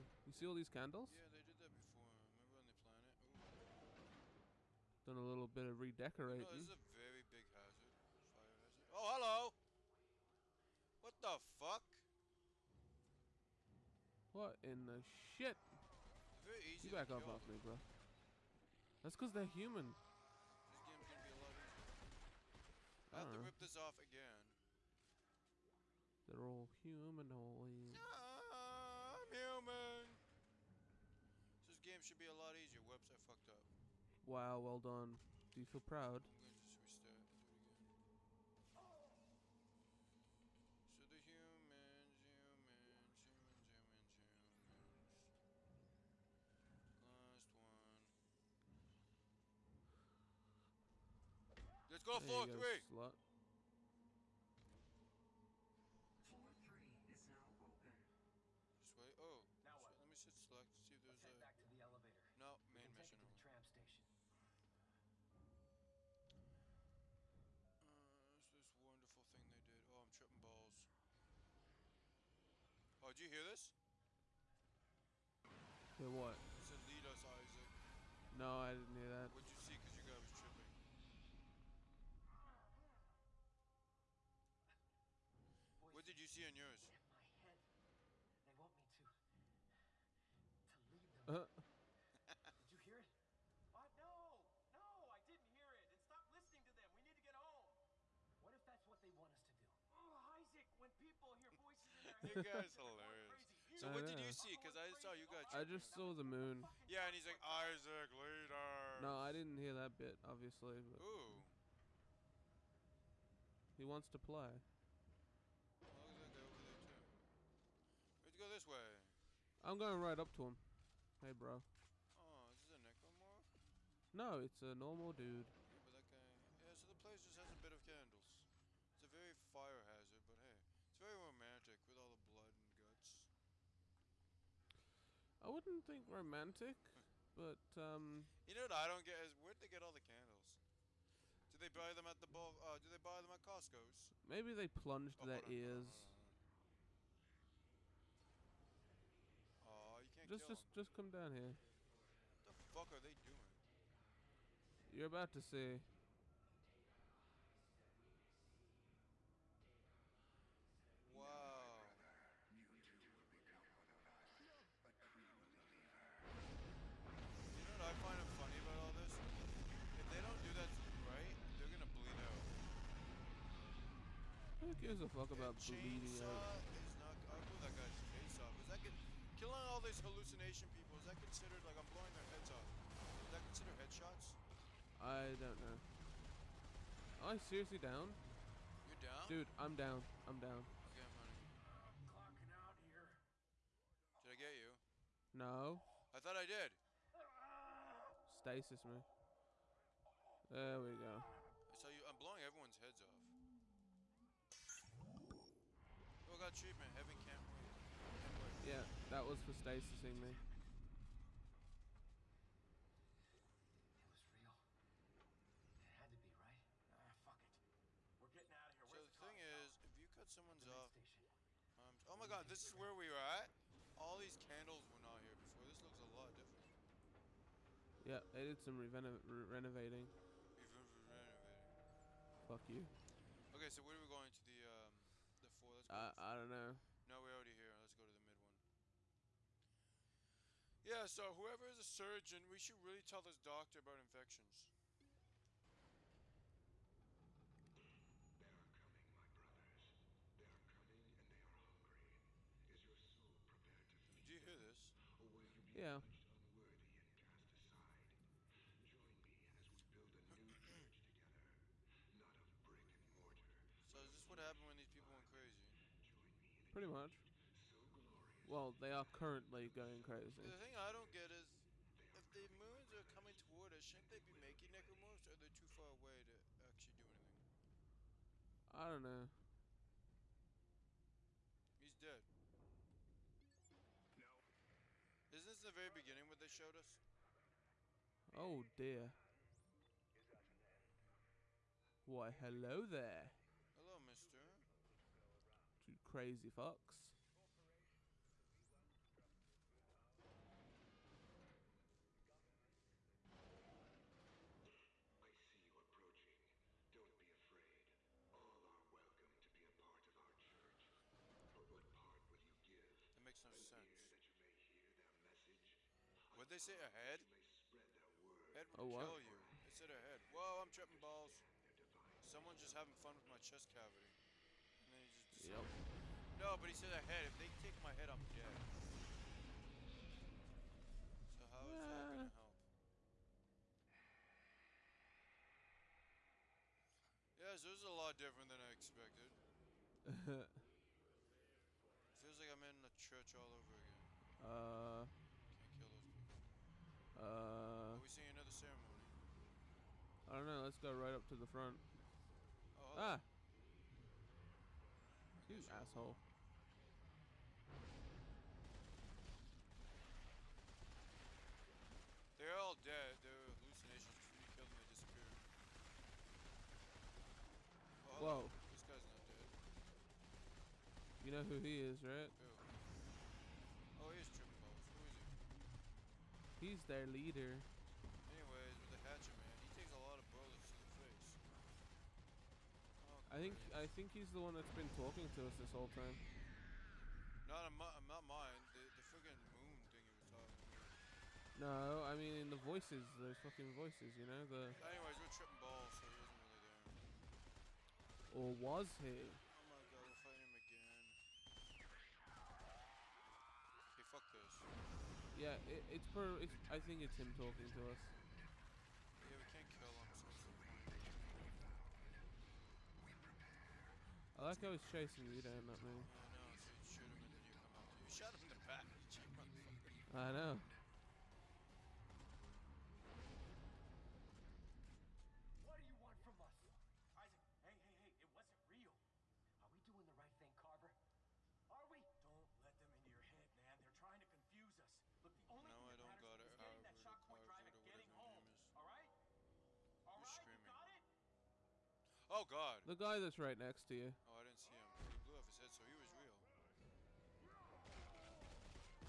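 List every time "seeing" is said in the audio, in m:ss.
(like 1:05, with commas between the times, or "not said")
5:48.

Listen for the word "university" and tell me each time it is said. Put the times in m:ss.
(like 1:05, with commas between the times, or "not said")
not said.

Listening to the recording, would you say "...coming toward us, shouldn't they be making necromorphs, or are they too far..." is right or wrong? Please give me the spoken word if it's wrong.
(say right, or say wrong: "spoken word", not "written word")
right.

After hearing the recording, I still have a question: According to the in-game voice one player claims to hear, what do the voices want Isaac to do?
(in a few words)
Lead them.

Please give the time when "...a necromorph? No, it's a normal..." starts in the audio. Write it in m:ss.
2:02.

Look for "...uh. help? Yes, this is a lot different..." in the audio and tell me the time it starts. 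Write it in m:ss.
5:32.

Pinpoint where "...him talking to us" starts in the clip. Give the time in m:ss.
6:47.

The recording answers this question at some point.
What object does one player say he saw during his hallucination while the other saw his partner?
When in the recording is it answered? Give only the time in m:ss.
1:46.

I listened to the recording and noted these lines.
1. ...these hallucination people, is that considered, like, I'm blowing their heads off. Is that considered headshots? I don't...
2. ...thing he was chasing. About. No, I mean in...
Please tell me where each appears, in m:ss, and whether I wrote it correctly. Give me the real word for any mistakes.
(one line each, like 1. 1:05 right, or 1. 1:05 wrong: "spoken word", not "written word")
1. 2:59 right
2. 6:29 wrong: "talking", not "chasing".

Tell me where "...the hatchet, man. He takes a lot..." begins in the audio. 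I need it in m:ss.
6:18.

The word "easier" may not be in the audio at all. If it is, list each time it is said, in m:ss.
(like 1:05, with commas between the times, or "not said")
0:21, 0:32.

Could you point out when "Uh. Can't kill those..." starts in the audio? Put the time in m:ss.
5:44.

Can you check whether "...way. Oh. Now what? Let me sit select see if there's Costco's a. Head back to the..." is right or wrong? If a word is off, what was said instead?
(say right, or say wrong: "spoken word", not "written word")
wrong: "Let", not "Costco".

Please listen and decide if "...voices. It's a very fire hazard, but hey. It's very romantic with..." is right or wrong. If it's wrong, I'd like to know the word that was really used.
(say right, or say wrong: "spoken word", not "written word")
wrong: "candles", not "voices".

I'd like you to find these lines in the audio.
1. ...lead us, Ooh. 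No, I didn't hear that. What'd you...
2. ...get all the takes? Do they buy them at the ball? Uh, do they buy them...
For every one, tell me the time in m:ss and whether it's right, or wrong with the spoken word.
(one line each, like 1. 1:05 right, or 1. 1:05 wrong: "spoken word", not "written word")
1. 1:16 wrong: "Isaac", not "Ooh"
2. 2:19 wrong: "candles", not "takes".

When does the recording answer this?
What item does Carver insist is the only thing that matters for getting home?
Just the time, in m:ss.
7:16.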